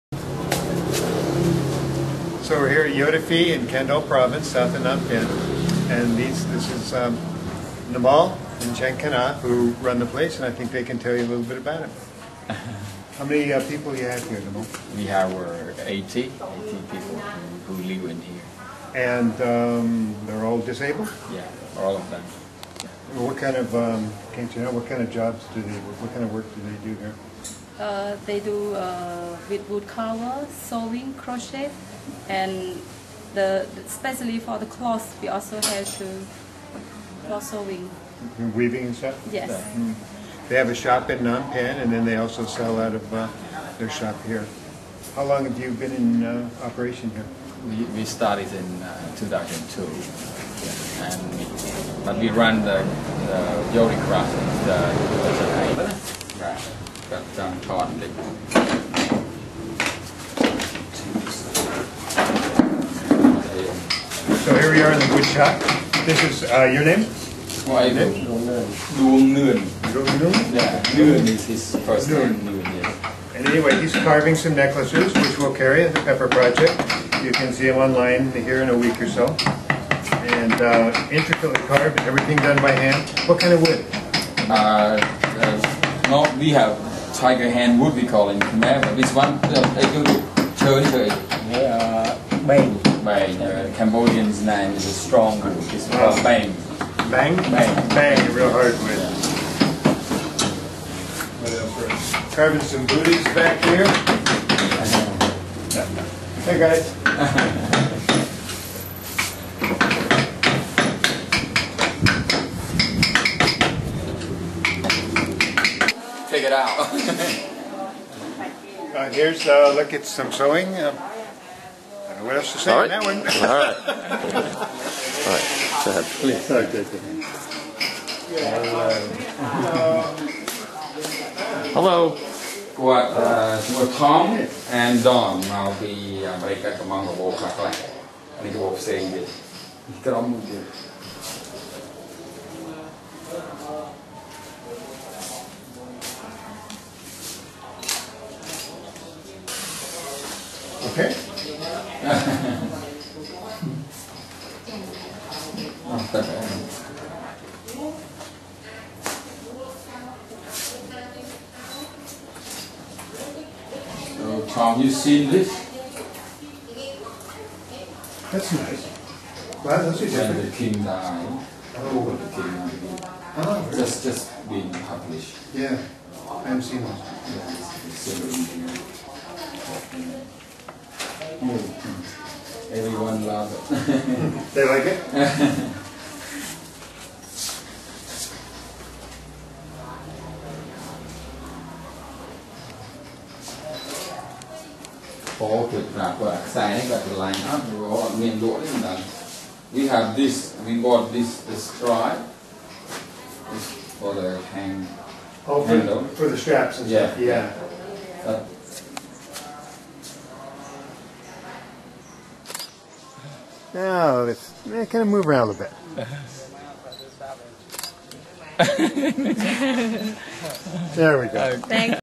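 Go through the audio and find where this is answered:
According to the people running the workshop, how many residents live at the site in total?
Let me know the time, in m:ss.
0:16.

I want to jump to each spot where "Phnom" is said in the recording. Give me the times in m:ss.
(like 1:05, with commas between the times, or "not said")
0:04, 0:41.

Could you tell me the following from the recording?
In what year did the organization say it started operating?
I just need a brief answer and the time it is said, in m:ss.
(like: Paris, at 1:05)
2002, at 0:49.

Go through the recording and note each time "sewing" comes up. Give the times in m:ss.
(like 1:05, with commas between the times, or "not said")
0:30, 0:37, 2:00.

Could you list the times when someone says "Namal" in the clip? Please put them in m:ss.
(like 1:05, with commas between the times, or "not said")
0:07, 0:14.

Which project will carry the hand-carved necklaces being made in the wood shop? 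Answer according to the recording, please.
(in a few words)
Pepper Project.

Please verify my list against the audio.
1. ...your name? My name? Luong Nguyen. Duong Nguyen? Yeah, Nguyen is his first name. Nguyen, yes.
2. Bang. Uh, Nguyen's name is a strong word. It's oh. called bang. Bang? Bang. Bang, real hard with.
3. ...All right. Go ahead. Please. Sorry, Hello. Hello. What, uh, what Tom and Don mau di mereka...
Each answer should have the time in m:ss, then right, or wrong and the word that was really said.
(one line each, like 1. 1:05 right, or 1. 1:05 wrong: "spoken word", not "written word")
1. 1:06 right
2. 1:33 wrong: "Cambodian", not "Nguyen"
3. 2:05 right.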